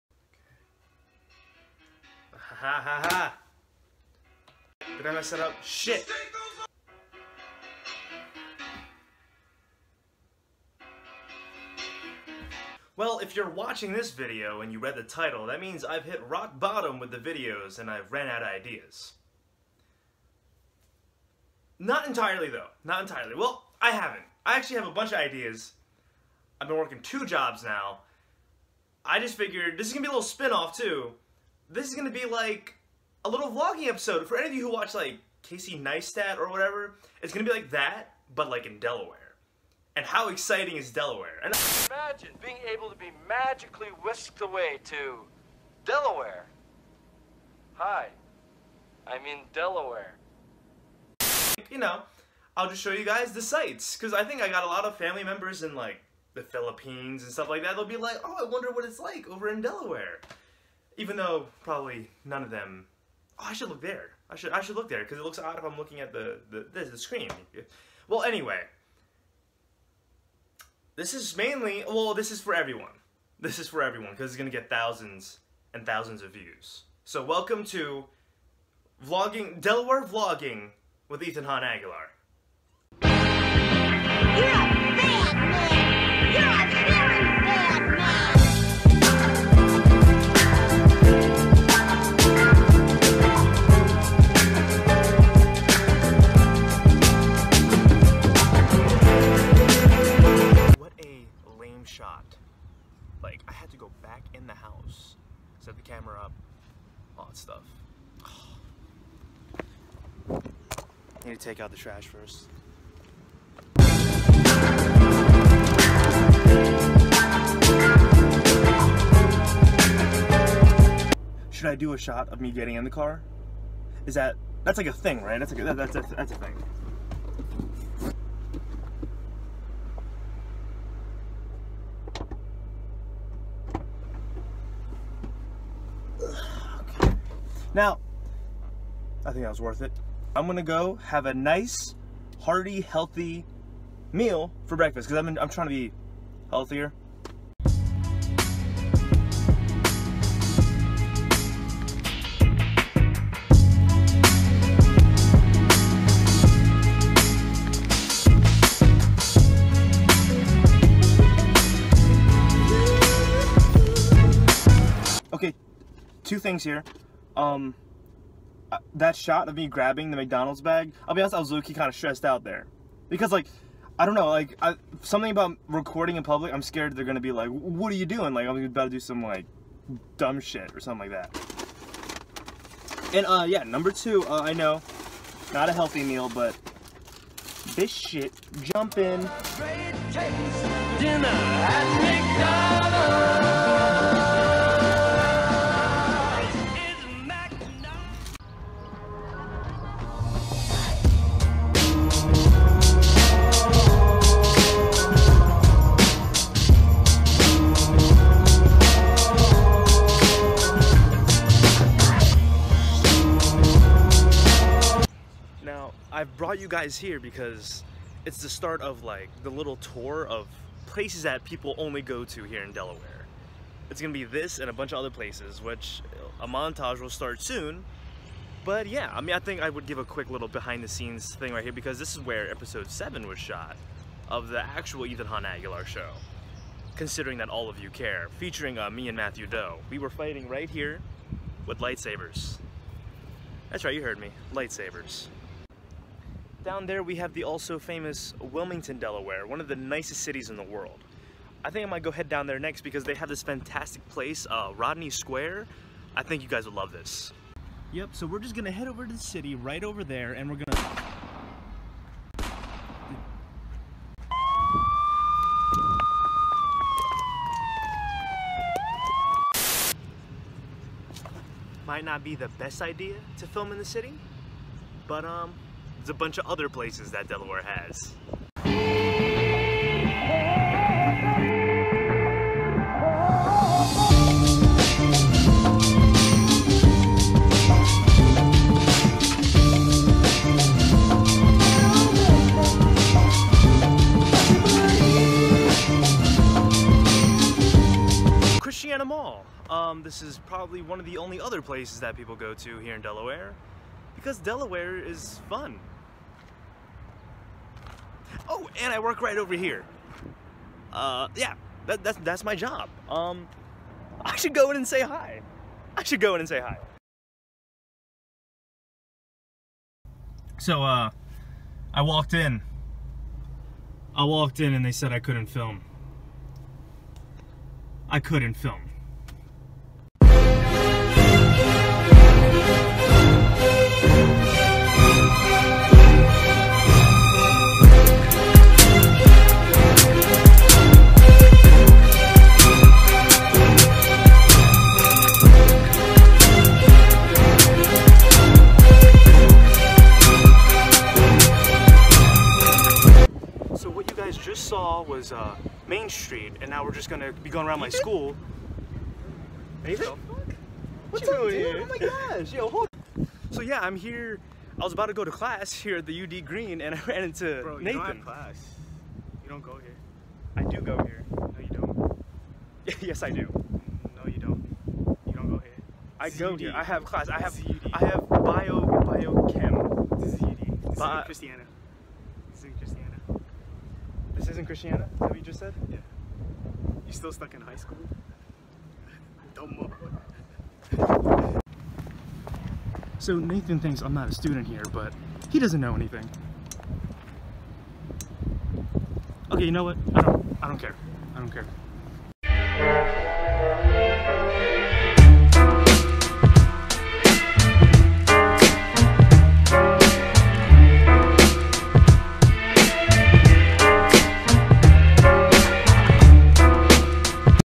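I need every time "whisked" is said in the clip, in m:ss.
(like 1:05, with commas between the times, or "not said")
0:44.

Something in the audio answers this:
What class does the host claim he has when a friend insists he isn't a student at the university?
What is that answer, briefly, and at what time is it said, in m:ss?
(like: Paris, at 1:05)
biochem, at 6:19.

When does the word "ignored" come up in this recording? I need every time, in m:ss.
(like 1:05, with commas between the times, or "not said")
not said.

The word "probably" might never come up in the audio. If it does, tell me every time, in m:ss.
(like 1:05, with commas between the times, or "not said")
1:01, 5:00.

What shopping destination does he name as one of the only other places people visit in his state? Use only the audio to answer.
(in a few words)
Christiana Mall.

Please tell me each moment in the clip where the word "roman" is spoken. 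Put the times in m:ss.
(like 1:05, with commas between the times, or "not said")
not said.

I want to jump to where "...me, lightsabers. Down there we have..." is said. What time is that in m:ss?
4:04.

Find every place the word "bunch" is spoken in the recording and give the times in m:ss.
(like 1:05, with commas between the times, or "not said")
0:24, 3:44, 4:36.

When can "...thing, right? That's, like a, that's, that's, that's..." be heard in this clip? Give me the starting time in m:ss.
2:04.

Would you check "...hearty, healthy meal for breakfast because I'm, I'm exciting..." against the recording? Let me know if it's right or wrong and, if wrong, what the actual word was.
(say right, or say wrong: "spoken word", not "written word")
wrong: "trying", not "exciting".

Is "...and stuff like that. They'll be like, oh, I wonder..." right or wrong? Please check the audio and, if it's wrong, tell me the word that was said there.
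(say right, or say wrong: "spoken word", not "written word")
right.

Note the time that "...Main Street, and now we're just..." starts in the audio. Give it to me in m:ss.
5:55.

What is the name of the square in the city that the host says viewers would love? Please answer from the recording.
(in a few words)
Rodney Square.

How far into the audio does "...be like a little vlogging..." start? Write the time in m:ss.
0:32.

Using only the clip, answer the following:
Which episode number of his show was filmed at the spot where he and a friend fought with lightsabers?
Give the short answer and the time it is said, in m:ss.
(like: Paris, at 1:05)
7, at 3:52.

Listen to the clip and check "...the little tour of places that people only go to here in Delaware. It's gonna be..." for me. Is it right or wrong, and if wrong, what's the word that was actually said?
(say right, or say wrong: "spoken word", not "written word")
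right.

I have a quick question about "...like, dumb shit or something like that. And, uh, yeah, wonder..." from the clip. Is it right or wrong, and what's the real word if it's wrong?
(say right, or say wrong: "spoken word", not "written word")
wrong: "number", not "wonder".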